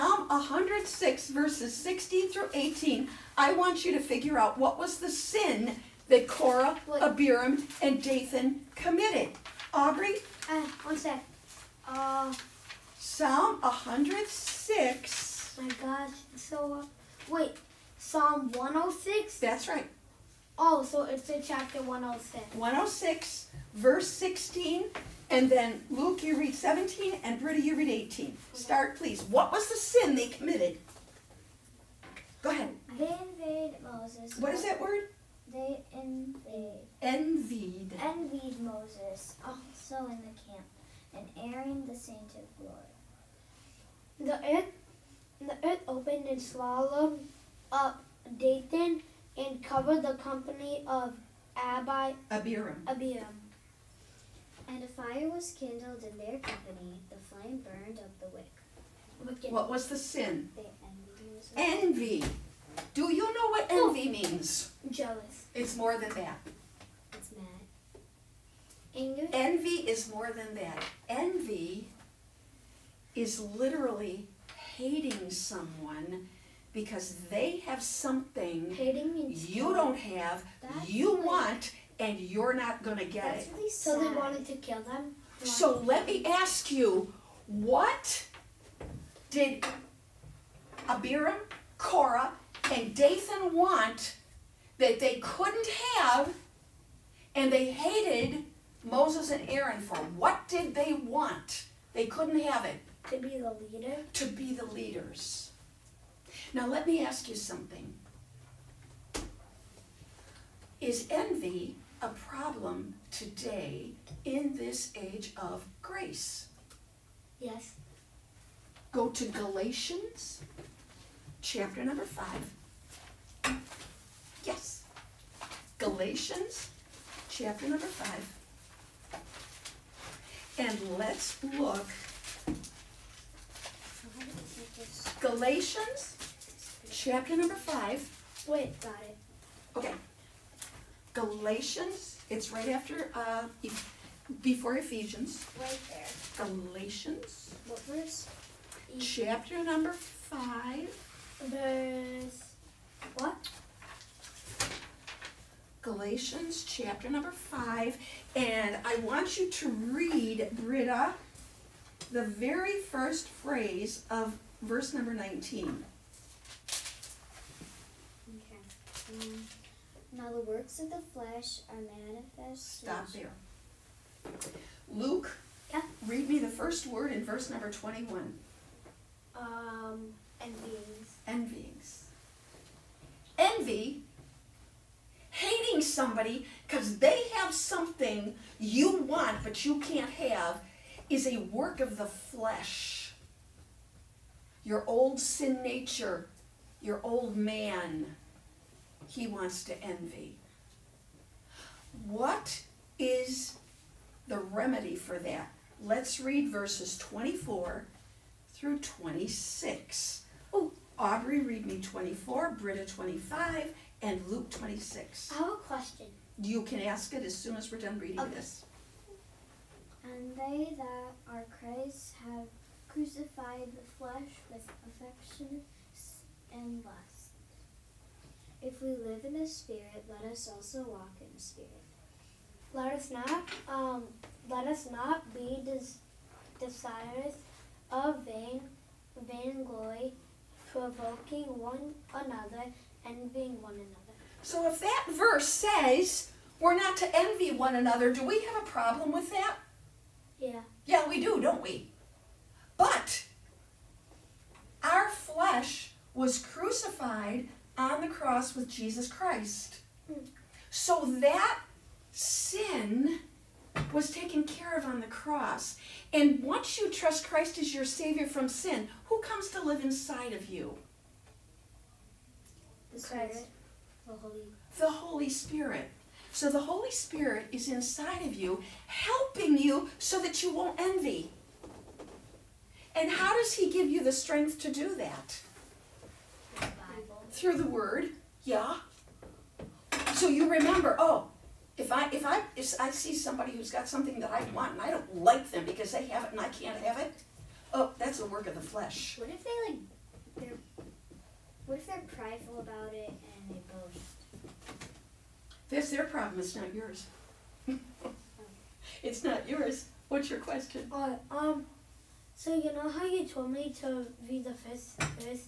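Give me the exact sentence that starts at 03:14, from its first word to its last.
Your old sin nature, your old man, he wants to envy.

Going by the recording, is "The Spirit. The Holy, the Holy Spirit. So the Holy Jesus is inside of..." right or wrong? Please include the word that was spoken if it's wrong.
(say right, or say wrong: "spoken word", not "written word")
wrong: "Spirit", not "Jesus".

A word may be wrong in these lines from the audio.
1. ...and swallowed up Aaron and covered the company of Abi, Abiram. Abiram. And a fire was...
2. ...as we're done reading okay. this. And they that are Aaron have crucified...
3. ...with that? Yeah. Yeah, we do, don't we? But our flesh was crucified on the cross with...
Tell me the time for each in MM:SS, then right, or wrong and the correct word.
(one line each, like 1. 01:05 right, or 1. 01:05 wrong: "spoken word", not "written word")
1. 00:46 wrong: "Dathan", not "Aaron"
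2. 03:37 wrong: "Christ", not "Aaron"
3. 04:09 right.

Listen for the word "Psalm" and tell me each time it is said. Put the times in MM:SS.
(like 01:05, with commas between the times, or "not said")
00:12, 00:17.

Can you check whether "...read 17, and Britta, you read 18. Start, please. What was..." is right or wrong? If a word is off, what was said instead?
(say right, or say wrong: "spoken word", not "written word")
right.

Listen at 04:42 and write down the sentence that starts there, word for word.
And how does He give you the strength to do that?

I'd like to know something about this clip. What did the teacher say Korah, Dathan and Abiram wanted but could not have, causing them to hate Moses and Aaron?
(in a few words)
To be the leaders.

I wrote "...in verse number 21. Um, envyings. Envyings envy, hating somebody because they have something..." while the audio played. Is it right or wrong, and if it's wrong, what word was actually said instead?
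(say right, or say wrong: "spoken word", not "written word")
right.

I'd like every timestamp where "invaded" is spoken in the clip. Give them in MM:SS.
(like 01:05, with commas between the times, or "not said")
00:33.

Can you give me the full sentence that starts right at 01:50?
Is envy a problem today in this age of grace?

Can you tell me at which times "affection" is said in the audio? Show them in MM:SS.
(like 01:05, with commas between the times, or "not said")
03:44.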